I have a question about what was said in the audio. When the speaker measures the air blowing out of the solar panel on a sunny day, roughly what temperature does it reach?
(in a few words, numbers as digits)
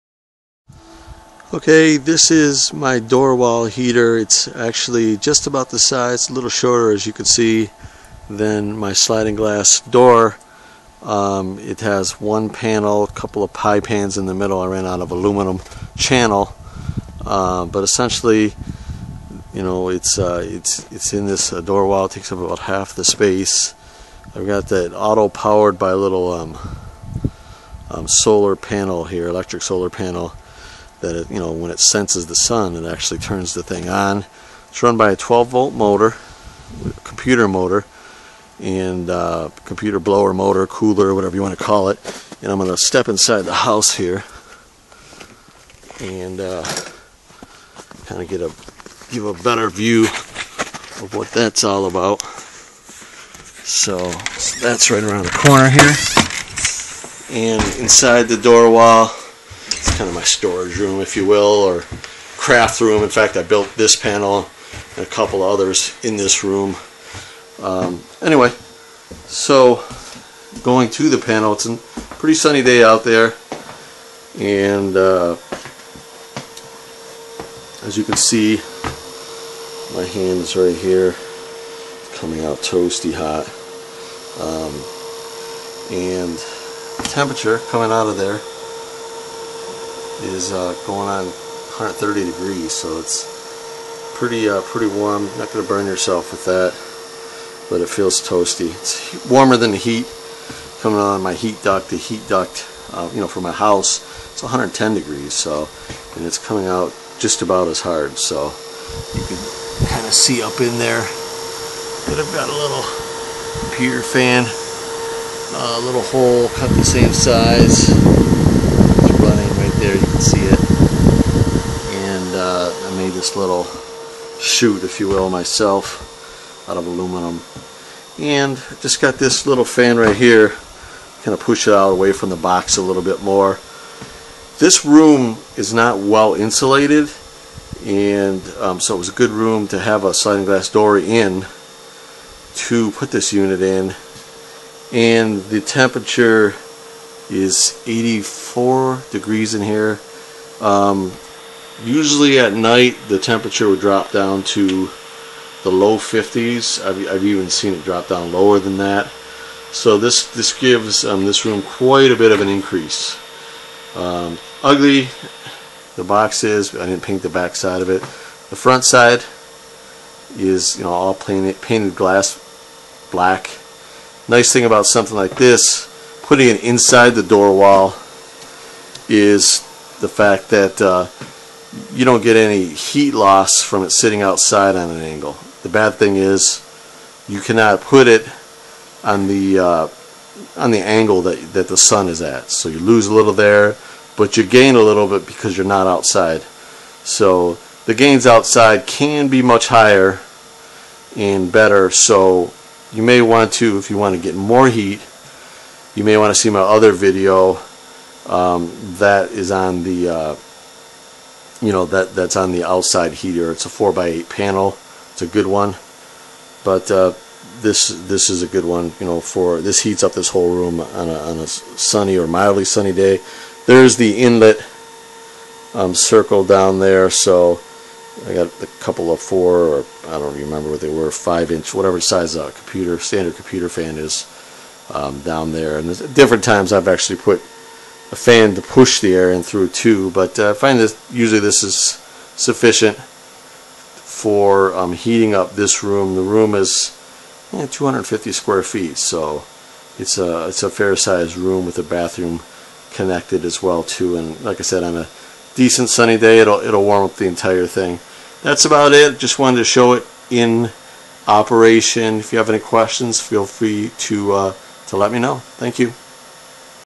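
130 degrees.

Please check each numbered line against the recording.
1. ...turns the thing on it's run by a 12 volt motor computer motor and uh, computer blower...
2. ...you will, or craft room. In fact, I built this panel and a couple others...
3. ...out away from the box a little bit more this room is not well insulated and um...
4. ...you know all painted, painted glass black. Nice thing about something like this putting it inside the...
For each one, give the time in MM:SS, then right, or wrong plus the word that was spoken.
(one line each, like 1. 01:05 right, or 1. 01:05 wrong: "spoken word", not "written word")
1. 00:33 right
2. 01:01 right
3. 02:11 right
4. 02:50 right.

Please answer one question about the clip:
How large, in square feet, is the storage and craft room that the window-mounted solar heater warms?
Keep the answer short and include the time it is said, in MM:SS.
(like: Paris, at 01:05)
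250 square feet, at 04:07.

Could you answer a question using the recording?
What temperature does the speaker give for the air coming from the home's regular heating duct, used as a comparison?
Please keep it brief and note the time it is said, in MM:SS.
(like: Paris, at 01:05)
110 degrees, at 01:44.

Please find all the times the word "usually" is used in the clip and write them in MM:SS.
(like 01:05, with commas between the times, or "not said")
02:31, 04:01.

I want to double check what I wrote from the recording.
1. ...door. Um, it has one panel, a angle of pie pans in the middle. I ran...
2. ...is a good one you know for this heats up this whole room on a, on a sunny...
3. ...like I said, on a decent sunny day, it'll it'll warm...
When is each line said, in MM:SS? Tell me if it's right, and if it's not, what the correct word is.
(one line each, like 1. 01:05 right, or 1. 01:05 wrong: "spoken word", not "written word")
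1. 00:09 wrong: "couple", not "angle"
2. 03:38 right
3. 04:14 right.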